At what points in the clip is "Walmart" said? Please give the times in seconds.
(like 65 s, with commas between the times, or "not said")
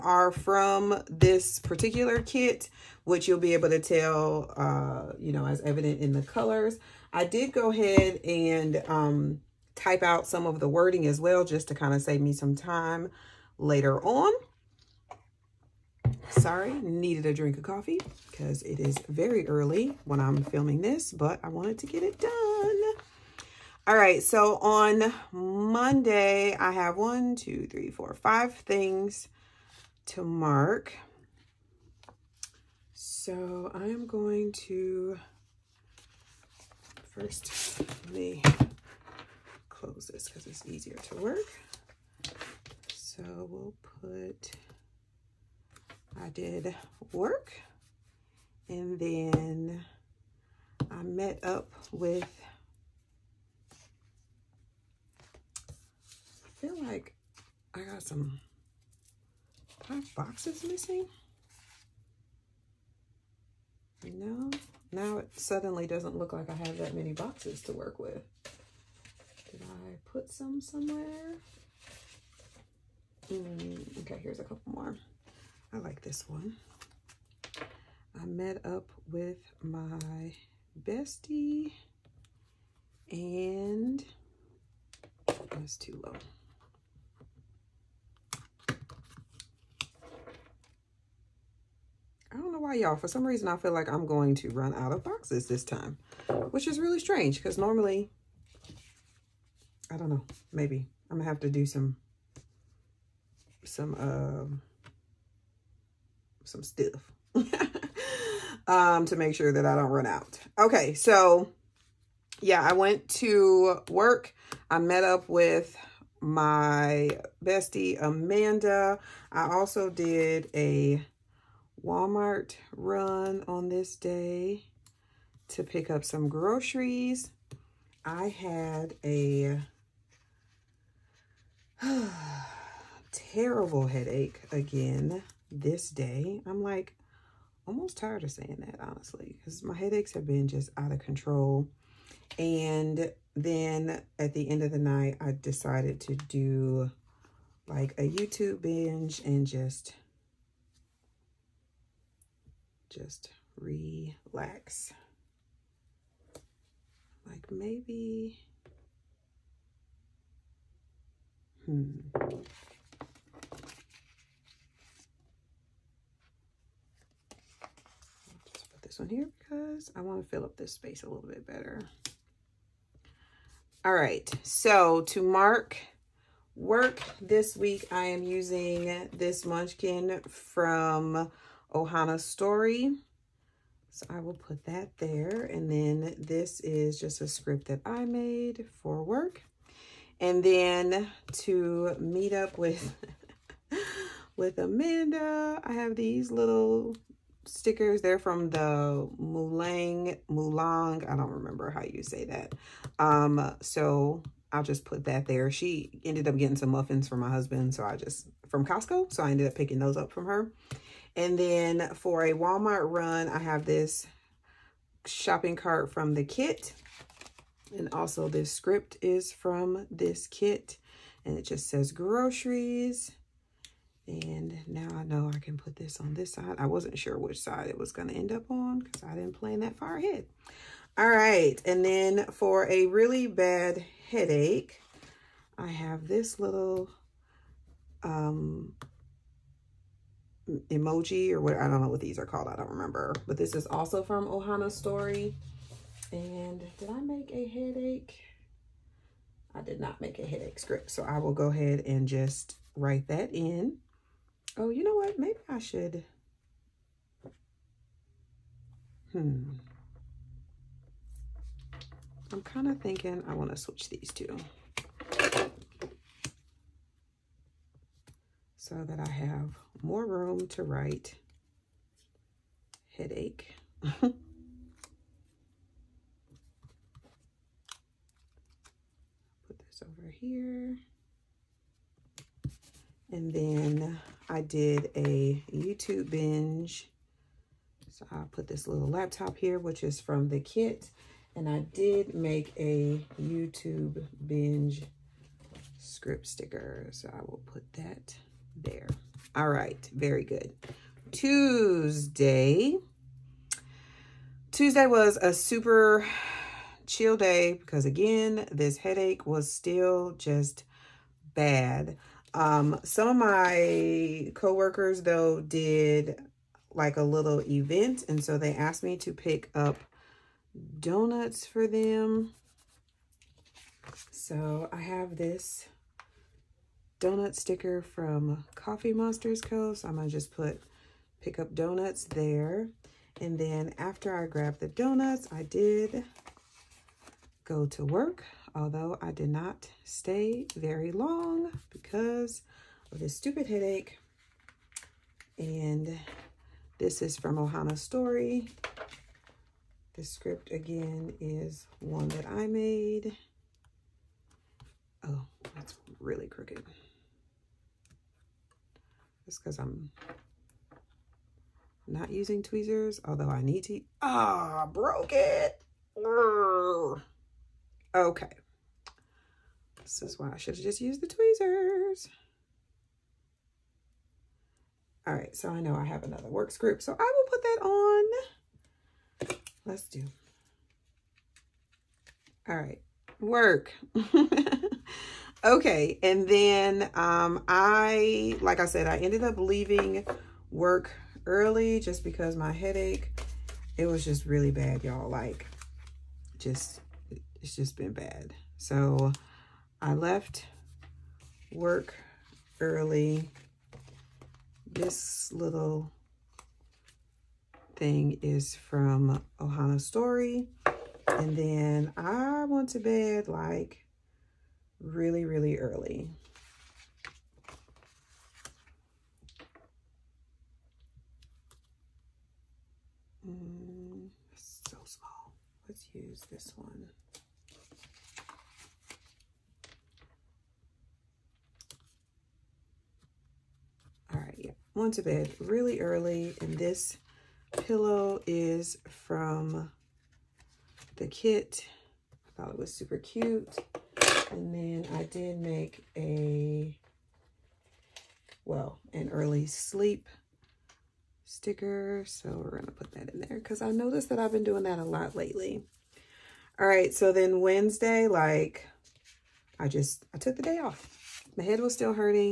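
121 s, 212 s.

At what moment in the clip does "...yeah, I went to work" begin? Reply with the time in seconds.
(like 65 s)
112 s.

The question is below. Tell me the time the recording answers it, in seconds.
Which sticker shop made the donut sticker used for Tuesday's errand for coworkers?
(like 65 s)
328 s.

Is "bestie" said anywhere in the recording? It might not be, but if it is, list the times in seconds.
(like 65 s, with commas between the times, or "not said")
80 s, 117 s.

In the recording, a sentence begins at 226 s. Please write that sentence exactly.
I wasn't sure which side it was going to end up on because I didn't plan that far ahead.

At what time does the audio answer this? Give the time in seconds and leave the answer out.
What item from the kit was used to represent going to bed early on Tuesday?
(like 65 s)
437 s.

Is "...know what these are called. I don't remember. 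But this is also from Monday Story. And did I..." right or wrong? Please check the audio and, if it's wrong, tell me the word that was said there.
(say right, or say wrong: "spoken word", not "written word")
wrong: "Ohana", not "Monday".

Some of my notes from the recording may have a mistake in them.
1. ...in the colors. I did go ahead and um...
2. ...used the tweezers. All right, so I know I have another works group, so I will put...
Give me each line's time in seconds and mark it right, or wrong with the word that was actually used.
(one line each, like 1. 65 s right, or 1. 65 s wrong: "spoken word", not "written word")
1. 6 s right
2. 370 s right.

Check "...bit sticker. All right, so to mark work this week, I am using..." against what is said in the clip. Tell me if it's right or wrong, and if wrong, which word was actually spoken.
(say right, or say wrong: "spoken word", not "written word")
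wrong: "better", not "sticker".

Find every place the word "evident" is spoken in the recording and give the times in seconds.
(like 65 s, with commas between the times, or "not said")
5 s.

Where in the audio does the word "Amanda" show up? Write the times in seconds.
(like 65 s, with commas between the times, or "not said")
118 s, 194 s.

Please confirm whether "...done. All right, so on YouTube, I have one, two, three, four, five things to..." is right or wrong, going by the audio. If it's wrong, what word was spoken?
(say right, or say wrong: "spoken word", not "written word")
wrong: "Monday", not "YouTube".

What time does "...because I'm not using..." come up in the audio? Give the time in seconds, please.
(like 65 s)
359 s.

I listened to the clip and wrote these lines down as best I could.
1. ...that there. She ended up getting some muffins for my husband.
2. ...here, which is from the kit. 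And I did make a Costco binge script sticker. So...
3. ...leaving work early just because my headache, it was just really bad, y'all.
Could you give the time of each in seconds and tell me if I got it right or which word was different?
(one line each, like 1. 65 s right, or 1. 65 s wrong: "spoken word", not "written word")
1. 205 s right
2. 289 s wrong: "YouTube", not "Costco"
3. 389 s right.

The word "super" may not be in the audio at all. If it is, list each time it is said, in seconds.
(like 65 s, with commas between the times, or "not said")
305 s, 442 s.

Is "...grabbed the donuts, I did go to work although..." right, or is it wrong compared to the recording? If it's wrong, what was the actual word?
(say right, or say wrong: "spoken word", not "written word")
right.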